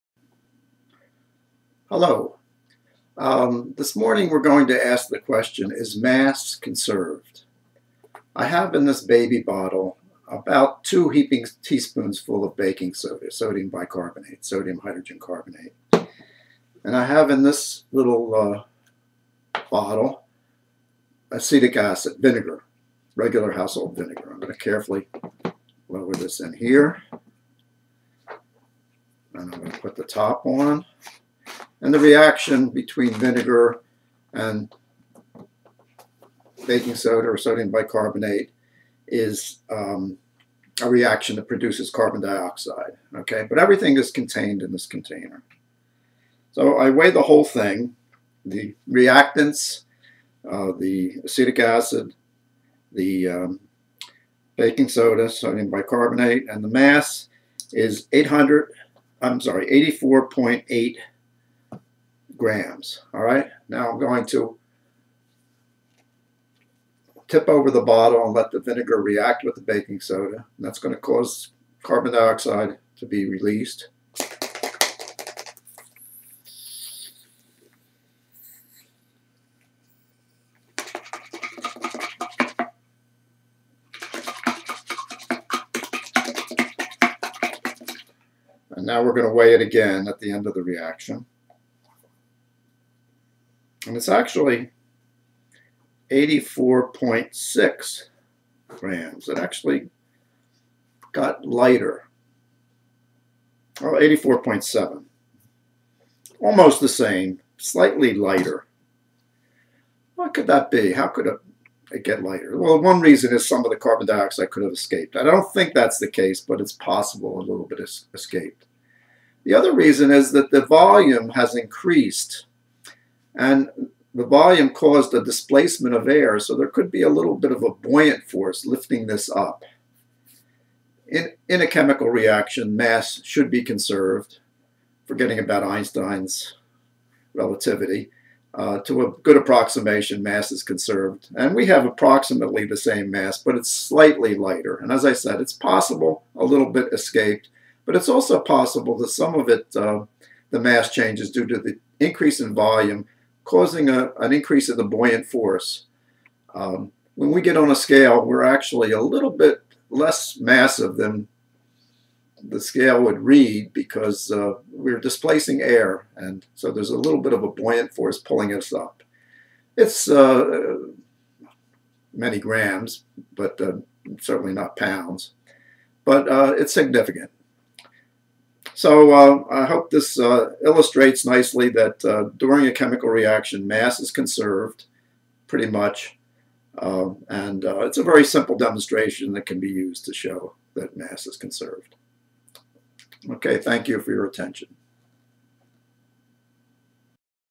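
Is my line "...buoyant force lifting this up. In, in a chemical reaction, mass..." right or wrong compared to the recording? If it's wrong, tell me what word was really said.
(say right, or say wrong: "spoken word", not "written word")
right.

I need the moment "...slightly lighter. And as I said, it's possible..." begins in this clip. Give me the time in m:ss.
2:23.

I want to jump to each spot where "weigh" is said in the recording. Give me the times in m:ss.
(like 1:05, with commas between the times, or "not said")
0:46, 1:29.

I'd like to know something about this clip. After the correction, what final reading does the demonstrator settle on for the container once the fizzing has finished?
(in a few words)
84.7.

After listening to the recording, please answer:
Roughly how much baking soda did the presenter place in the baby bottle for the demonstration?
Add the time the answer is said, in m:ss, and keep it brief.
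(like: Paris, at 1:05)
two heaping teaspoons, at 0:10.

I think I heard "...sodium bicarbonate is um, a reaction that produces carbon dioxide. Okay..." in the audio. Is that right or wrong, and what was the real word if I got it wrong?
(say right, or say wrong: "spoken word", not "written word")
right.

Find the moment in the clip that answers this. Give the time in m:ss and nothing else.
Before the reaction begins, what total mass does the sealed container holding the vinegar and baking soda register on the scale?
0:59.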